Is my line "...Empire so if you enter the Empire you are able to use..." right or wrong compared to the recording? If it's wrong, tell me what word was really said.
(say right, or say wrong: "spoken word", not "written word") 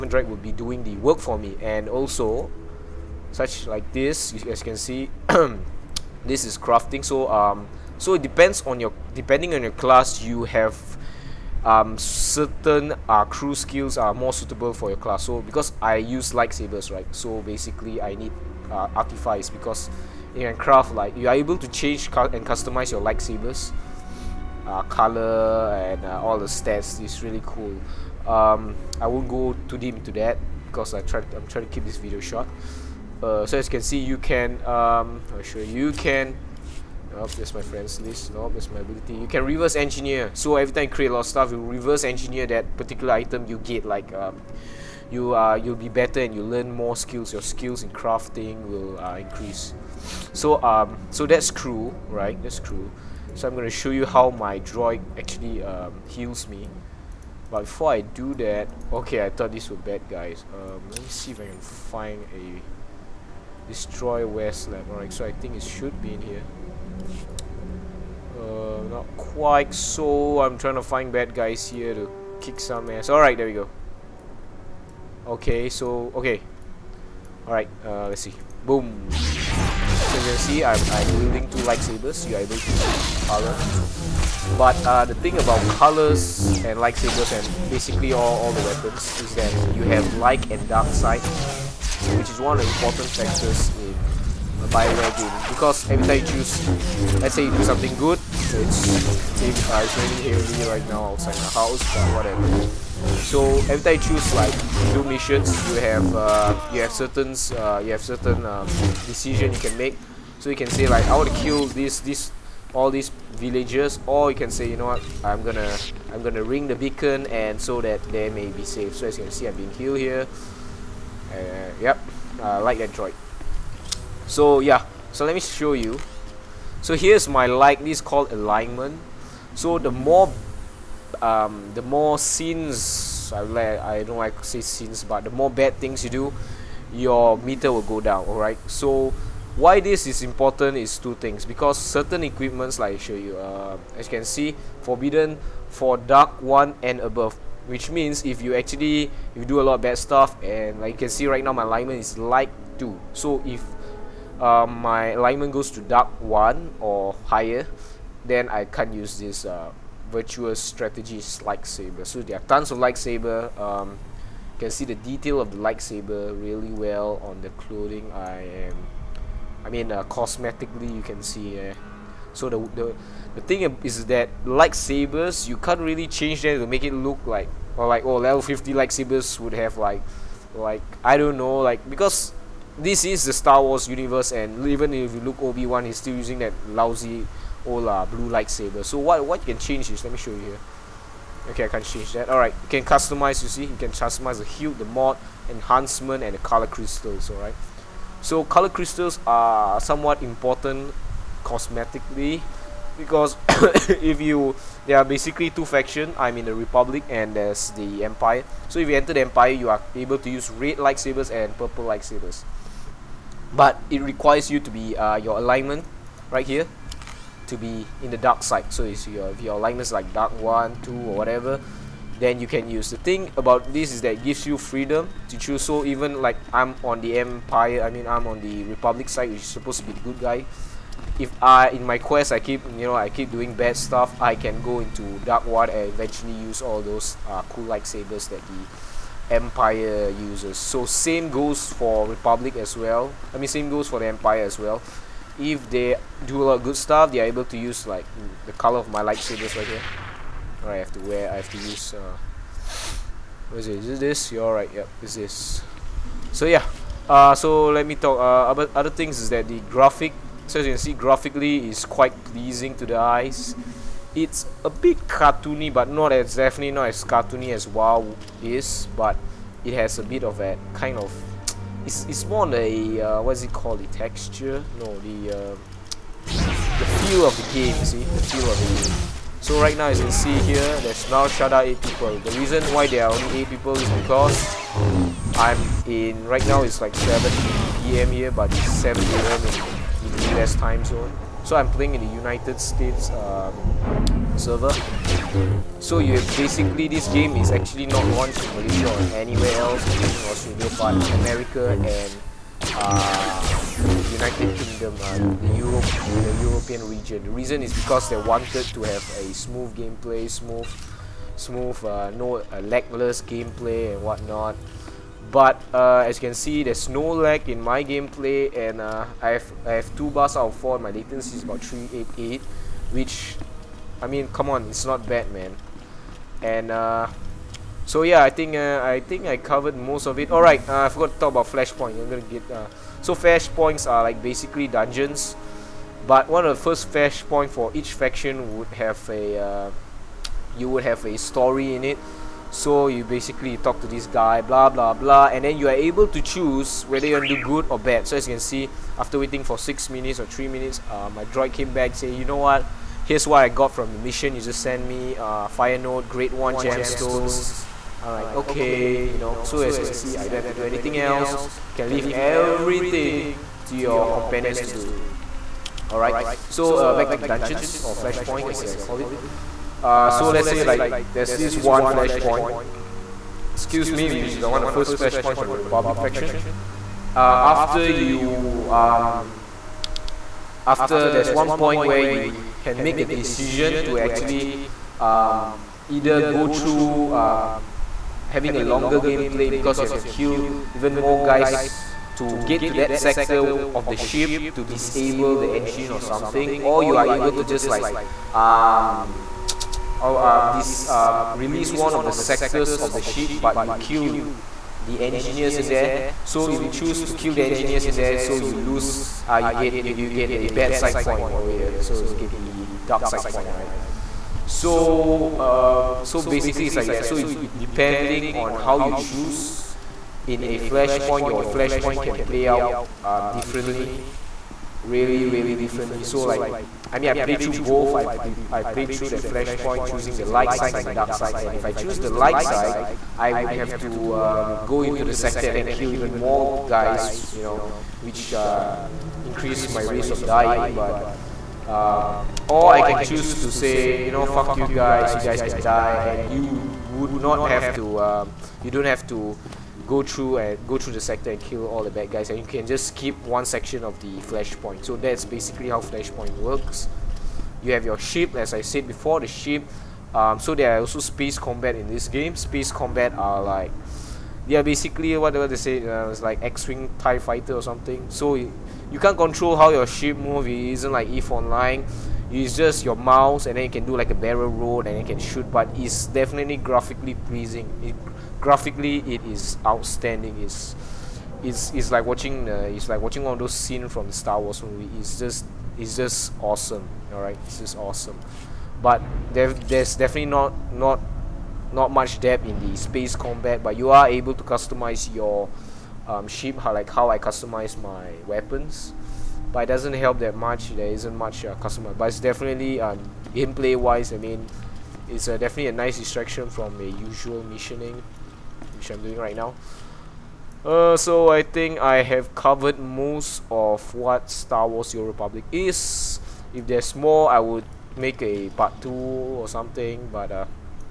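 right.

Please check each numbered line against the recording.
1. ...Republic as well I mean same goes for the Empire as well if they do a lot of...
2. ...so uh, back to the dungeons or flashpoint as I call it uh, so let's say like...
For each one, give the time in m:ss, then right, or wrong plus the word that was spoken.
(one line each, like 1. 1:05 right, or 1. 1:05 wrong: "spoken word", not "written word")
1. 4:02 right
2. 6:06 right.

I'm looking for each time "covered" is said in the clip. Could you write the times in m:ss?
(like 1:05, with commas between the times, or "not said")
5:29, 8:32.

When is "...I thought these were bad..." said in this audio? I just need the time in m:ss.
0:59.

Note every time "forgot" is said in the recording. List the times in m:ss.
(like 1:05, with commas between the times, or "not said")
5:30.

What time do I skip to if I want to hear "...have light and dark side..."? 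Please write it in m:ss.
1:29.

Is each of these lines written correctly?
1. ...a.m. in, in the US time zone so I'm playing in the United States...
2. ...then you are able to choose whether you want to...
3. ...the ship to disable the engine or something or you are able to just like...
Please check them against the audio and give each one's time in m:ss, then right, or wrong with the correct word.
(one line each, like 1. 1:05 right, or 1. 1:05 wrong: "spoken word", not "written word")
1. 4:49 right
2. 5:45 right
3. 6:33 right.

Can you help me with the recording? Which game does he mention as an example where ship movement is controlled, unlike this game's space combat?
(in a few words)
EVE Online.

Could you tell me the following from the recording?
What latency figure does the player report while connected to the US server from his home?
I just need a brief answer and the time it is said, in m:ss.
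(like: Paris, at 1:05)
388, at 5:21.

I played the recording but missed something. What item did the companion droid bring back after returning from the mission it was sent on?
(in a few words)
Fire node grade 1 gemstones.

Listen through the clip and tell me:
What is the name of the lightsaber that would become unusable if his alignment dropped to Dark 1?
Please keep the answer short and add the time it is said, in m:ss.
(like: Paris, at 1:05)
Virtuous strategies, at 2:40.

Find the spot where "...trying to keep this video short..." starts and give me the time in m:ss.
0:31.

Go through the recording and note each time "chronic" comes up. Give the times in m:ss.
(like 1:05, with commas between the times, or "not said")
not said.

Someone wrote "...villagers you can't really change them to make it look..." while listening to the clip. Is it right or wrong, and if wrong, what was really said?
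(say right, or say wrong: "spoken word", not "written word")
wrong: "lightsabers", not "villagers".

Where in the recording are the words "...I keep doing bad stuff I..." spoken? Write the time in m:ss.
3:52.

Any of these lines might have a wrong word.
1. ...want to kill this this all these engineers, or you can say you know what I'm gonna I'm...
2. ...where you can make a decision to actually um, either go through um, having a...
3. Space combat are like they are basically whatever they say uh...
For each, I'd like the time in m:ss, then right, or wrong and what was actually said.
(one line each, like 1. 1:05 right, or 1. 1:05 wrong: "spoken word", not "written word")
1. 1:51 wrong: "villagers", not "engineers"
2. 6:21 right
3. 7:42 right.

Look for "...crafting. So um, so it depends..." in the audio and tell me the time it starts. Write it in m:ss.
0:06.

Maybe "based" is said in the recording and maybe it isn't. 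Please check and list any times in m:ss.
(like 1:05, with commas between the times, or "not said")
not said.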